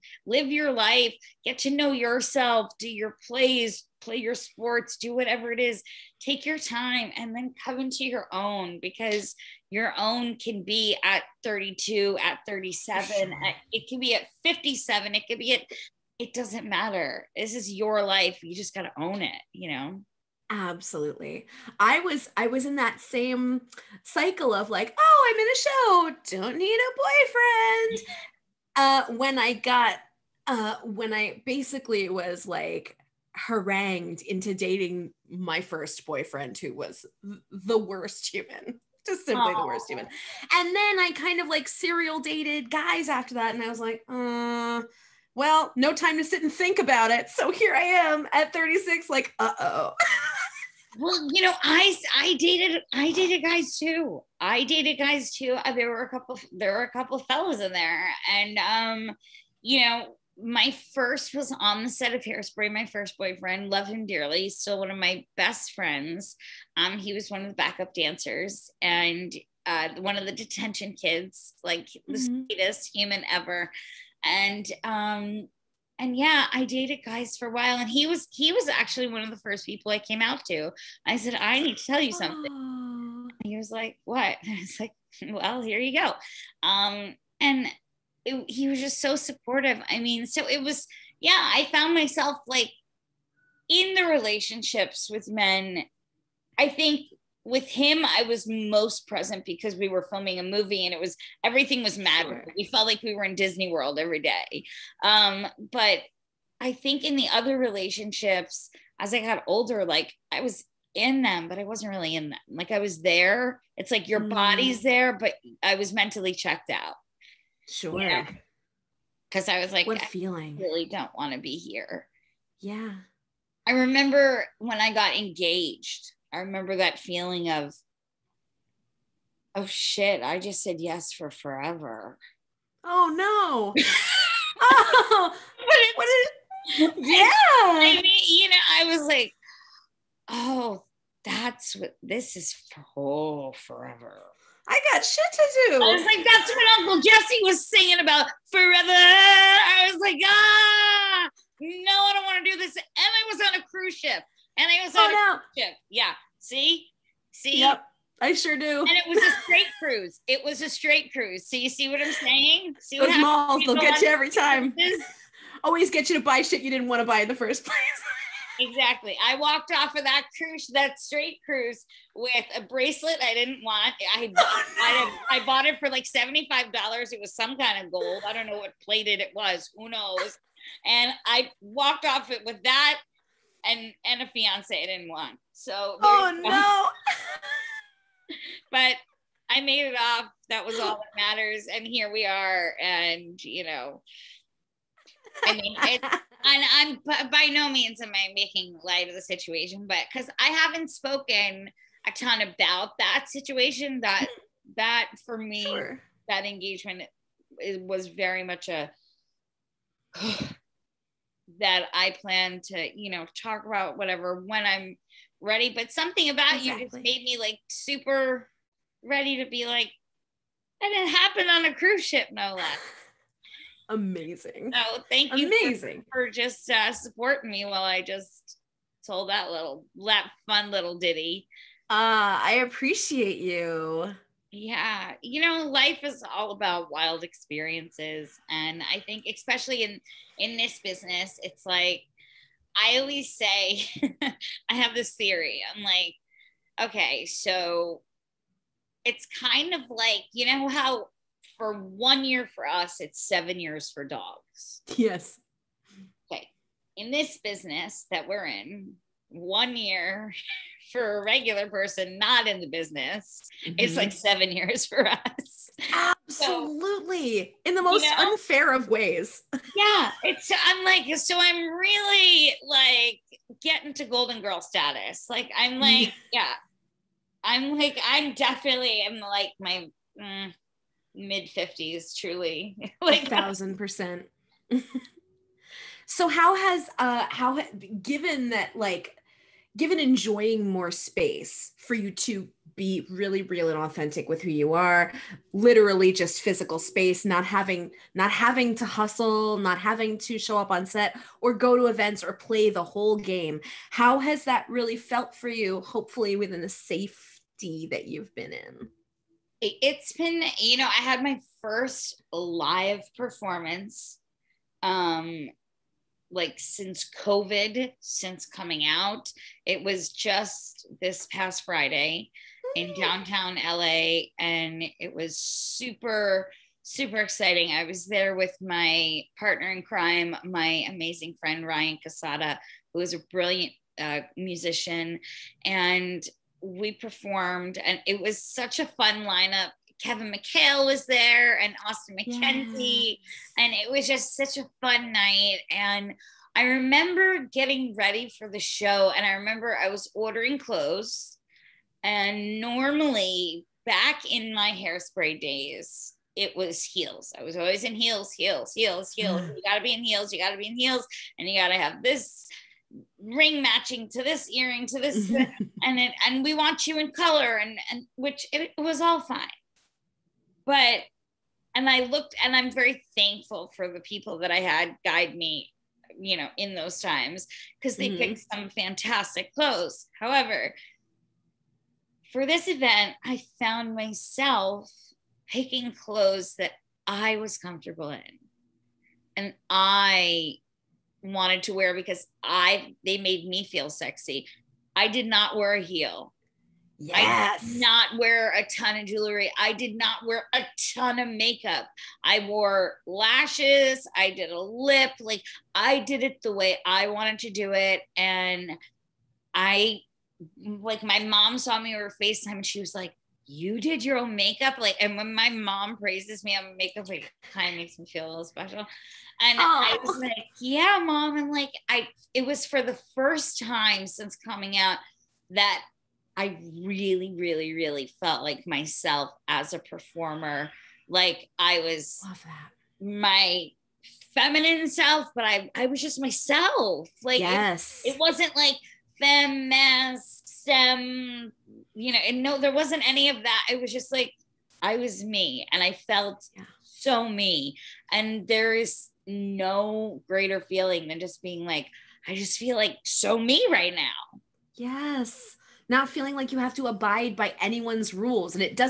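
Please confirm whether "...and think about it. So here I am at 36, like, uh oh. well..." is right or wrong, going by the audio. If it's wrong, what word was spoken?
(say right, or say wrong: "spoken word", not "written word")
right.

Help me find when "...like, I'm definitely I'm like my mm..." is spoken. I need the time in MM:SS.
04:37.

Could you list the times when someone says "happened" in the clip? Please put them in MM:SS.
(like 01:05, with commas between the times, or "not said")
03:41.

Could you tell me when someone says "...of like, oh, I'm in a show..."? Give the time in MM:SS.
00:24.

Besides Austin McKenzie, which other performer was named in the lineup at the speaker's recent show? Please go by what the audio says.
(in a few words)
Kevin McHale.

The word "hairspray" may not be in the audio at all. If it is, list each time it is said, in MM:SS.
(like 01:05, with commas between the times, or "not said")
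01:02, 05:54.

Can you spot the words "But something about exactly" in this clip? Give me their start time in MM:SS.
03:35.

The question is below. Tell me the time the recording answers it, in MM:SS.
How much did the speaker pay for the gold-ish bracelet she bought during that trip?
02:56.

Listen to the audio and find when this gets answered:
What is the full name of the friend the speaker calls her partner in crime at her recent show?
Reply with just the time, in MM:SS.
05:31.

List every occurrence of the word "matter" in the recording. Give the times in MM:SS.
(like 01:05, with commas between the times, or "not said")
00:16, 03:11.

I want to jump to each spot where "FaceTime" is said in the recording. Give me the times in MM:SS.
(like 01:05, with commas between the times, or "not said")
06:52.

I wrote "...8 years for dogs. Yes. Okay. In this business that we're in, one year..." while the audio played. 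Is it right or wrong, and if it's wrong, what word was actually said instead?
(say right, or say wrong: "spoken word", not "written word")
wrong: "7", not "8".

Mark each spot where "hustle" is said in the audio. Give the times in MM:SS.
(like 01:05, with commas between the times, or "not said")
04:58.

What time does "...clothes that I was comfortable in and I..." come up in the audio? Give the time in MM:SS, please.
06:25.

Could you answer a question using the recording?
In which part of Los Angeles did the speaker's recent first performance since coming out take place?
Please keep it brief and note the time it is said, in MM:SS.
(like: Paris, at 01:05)
Downtown LA, at 05:22.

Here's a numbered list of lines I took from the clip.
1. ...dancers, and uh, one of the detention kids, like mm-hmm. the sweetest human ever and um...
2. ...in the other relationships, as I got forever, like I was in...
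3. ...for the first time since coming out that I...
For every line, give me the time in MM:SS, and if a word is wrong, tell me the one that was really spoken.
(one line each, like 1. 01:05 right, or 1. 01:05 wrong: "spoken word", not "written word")
1. 01:07 right
2. 01:47 wrong: "older", not "forever"
3. 07:02 right.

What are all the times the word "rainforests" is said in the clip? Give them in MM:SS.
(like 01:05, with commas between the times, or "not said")
not said.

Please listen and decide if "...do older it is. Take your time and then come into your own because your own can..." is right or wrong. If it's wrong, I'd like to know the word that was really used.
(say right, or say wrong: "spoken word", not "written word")
wrong: "whatever", not "older".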